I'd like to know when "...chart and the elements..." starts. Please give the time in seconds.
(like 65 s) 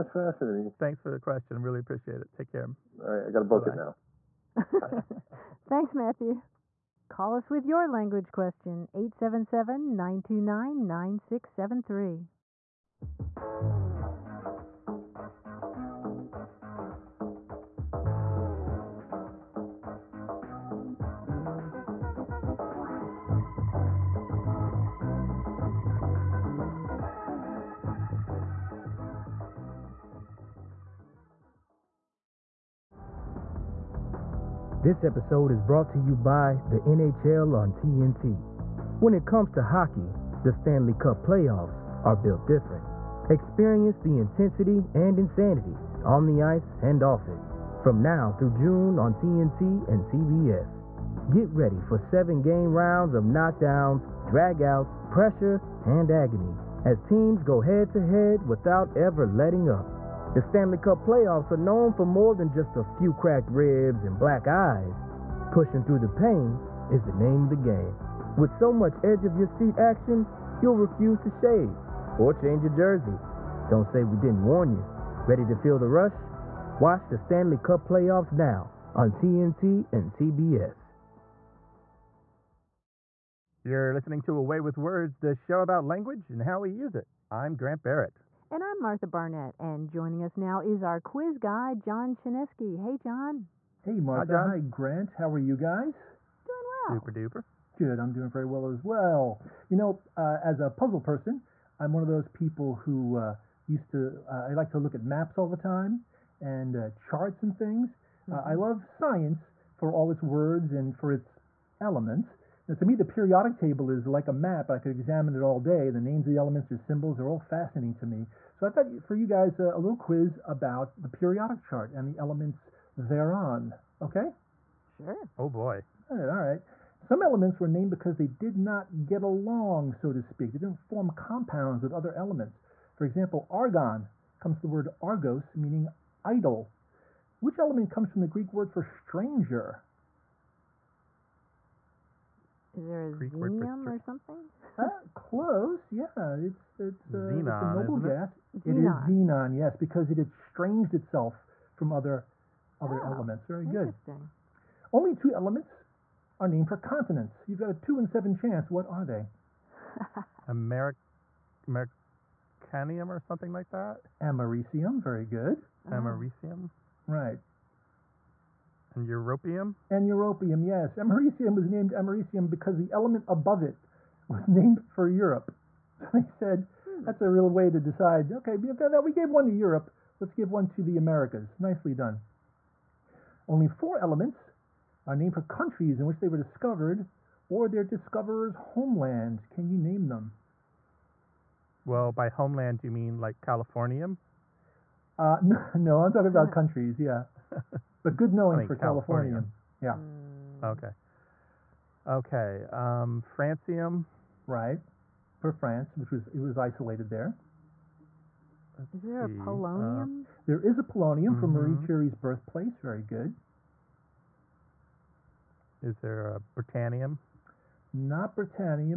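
121 s.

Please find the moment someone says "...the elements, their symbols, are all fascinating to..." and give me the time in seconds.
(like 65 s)
116 s.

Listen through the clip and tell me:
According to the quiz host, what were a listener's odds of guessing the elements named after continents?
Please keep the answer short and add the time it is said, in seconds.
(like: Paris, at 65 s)
2 in 7, at 157 s.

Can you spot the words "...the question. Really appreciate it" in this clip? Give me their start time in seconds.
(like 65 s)
1 s.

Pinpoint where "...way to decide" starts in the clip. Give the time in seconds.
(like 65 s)
177 s.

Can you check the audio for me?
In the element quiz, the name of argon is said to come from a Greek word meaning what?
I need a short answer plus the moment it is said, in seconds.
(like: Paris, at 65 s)
idle, at 136 s.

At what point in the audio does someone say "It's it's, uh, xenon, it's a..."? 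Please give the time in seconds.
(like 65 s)
146 s.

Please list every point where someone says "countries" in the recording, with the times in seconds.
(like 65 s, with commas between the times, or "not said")
185 s, 196 s.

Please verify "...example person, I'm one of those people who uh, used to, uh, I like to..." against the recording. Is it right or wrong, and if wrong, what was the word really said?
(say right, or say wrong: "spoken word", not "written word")
wrong: "puzzle", not "example".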